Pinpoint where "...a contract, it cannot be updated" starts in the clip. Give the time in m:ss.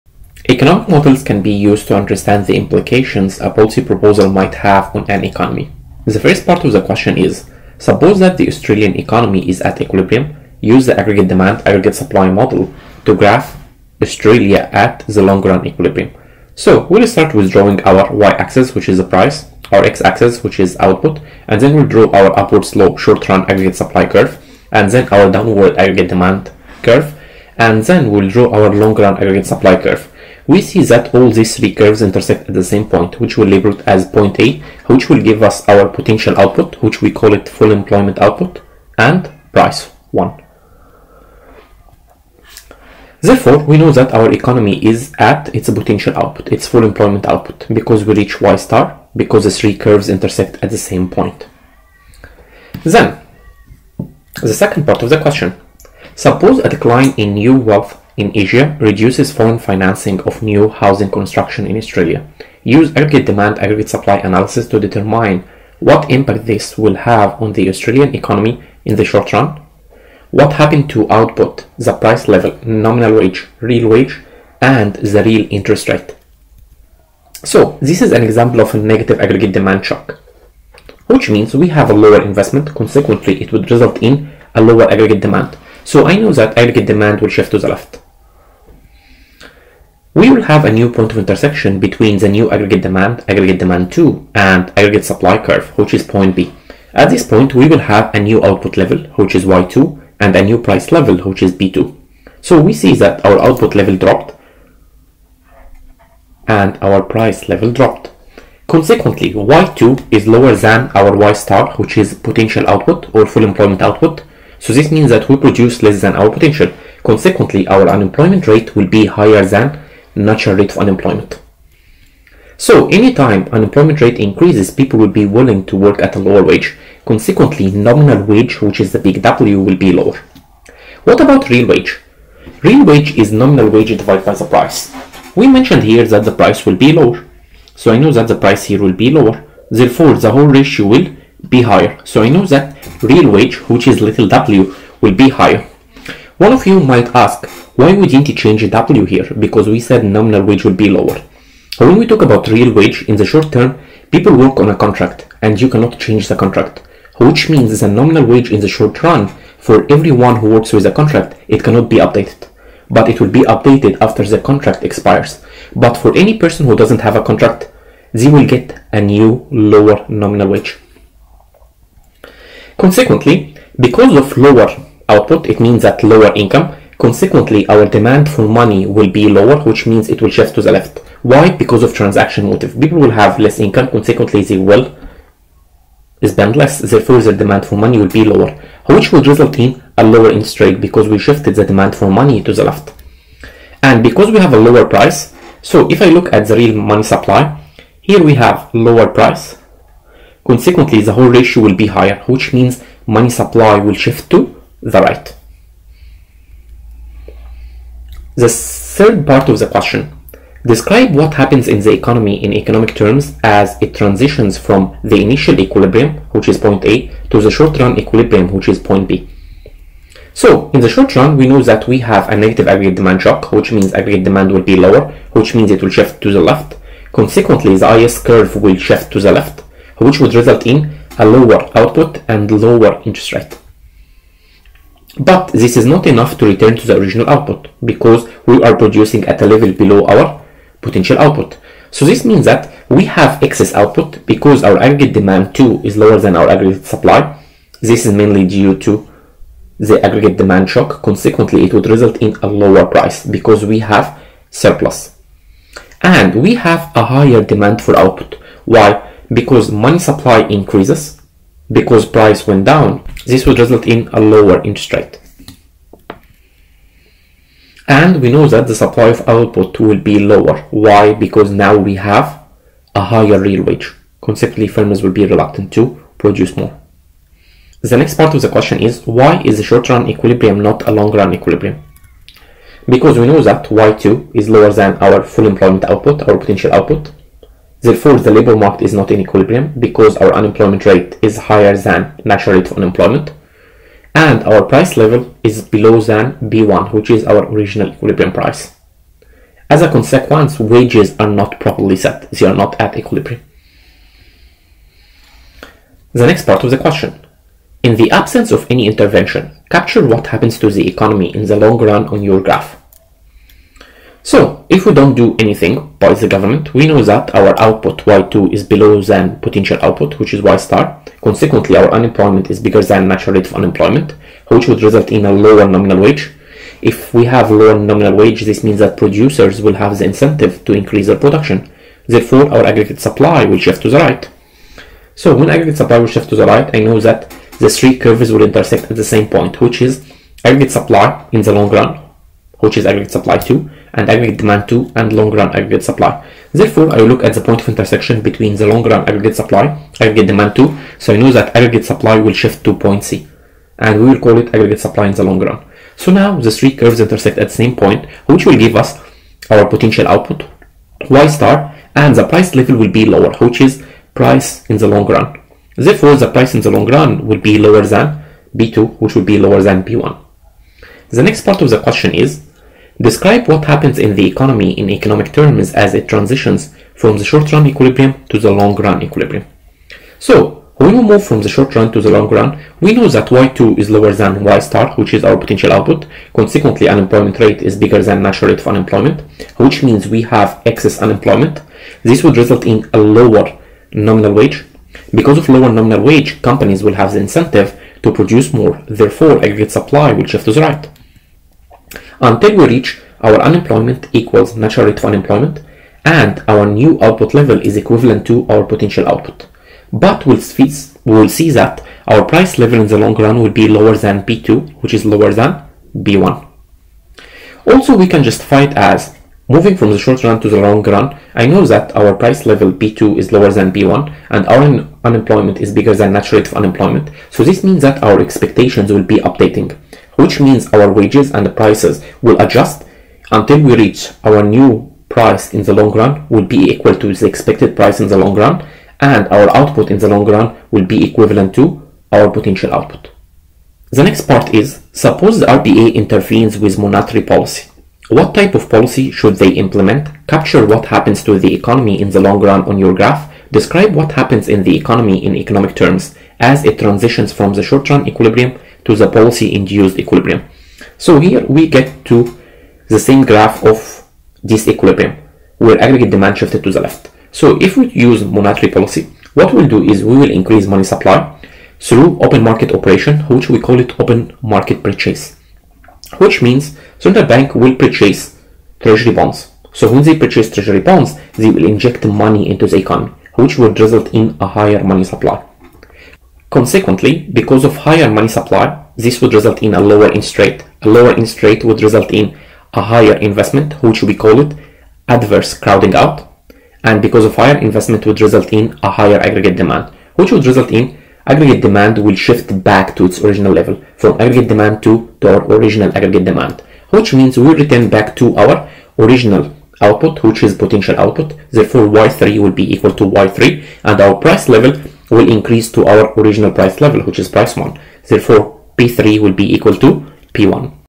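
2:40.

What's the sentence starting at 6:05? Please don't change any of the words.
Therefore, the price in the long run will be lower than P2 which will be lower than P1.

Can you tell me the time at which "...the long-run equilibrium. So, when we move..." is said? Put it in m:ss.
6:18.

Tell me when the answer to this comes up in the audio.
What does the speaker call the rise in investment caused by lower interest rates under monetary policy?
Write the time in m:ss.
8:15.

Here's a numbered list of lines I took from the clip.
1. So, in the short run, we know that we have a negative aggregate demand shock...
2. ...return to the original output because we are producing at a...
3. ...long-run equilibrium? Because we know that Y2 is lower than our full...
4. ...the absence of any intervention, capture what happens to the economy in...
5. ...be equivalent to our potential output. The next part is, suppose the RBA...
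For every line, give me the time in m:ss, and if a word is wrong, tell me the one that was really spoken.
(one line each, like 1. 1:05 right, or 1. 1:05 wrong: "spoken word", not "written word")
1. 3:40 right
2. 3:56 right
3. 4:40 right
4. 5:07 right
5. 7:20 right.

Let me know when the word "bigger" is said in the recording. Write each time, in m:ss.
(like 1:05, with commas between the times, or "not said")
5:22, 6:27, 7:05.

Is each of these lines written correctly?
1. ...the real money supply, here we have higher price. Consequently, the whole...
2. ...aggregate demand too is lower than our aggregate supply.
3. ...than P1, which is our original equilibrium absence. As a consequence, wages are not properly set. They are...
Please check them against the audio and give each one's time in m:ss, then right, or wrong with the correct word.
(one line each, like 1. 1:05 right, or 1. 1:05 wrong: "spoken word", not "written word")
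1. 3:16 wrong: "lower", not "higher"
2. 4:04 right
3. 4:55 wrong: "price", not "absence".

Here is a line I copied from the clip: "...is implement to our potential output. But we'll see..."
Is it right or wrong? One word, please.
wrong.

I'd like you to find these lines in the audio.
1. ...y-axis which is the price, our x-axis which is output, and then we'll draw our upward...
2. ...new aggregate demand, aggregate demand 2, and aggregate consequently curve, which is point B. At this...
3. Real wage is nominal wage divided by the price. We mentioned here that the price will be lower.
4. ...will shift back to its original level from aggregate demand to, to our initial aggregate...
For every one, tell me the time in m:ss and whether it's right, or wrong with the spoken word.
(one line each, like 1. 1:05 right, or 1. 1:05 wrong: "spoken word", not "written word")
1. 0:18 right
2. 1:32 wrong: "supply", not "consequently"
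3. 2:12 right
4. 8:21 wrong: "original", not "initial".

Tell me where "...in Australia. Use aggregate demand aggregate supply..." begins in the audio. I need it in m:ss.
1:01.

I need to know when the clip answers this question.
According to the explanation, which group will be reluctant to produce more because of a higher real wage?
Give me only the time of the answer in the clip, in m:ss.
4:34.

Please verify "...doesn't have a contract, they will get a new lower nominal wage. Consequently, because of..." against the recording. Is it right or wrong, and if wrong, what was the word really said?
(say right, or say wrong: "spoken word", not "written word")
right.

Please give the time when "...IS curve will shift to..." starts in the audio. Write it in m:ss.
3:47.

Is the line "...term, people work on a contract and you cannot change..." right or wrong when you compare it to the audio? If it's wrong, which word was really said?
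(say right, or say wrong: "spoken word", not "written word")
right.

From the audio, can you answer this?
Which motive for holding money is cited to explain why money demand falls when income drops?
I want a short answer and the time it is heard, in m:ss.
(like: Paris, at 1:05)
Transaction motive, at 3:01.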